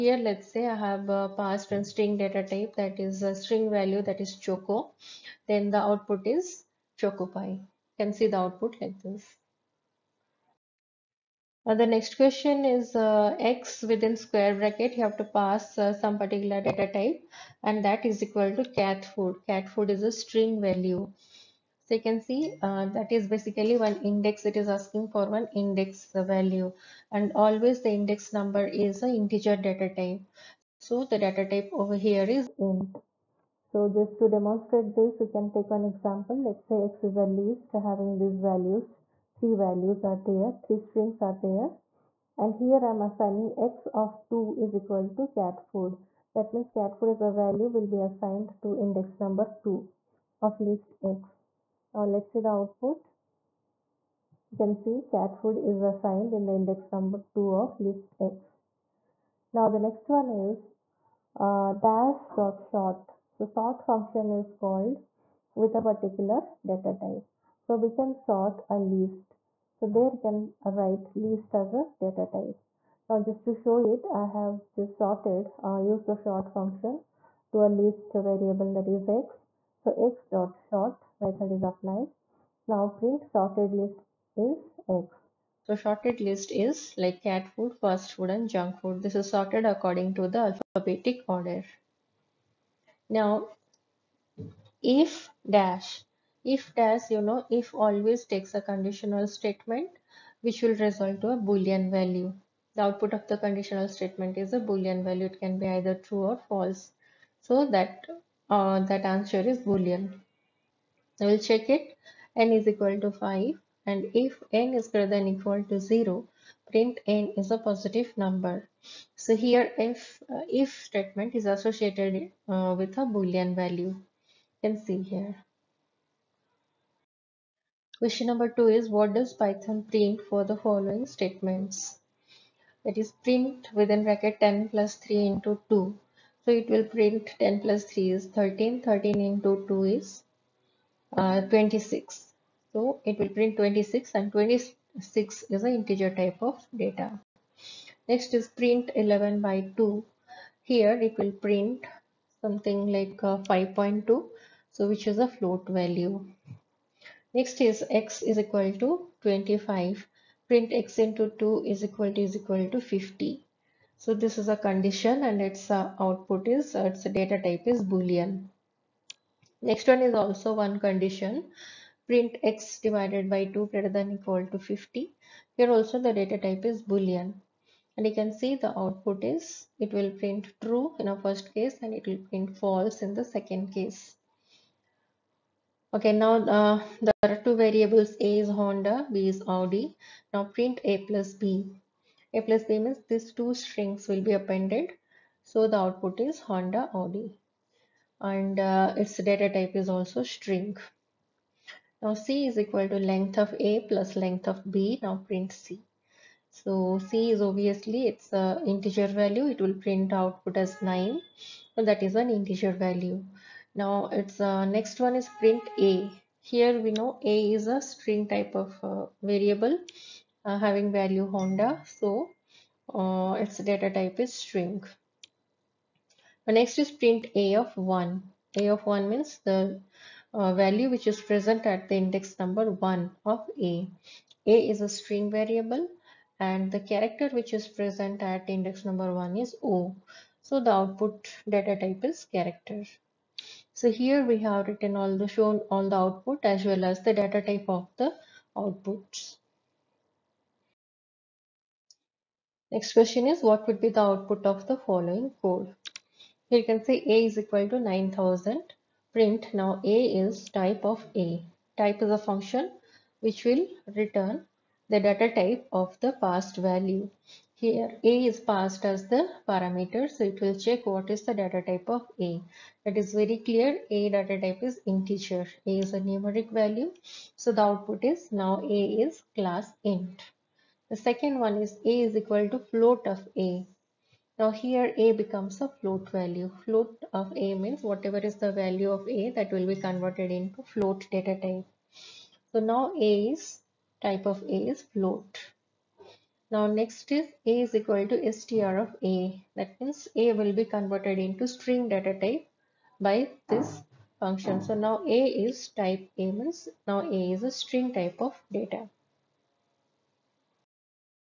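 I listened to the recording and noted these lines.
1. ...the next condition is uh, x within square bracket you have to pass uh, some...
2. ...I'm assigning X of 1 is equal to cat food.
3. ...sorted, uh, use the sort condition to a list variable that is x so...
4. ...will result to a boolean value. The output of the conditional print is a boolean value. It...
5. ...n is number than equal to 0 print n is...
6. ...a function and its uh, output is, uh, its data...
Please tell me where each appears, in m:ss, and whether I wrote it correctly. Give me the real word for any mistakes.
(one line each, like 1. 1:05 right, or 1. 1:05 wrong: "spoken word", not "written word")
1. 0:11 wrong: "question", not "condition"
2. 0:42 wrong: "2", not "1"
3. 1:14 wrong: "function", not "condition"
4. 1:40 wrong: "statement", not "print"
5. 1:54 wrong: "greater", not "number"
6. 2:44 wrong: "condition", not "function".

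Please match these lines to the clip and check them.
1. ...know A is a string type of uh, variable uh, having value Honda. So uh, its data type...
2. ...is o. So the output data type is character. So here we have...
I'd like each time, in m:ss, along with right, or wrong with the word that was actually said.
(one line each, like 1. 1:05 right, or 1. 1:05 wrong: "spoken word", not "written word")
1. 3:36 right
2. 3:59 right.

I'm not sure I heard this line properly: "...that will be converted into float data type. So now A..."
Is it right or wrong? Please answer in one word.
right.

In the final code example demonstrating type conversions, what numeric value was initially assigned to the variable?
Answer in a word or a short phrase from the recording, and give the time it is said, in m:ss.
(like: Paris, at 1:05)
9000, at 4:17.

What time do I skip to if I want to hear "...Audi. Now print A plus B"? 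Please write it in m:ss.
3:09.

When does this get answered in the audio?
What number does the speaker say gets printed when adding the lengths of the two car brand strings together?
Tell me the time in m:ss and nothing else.
3:30.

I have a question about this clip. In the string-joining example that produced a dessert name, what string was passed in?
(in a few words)
choco.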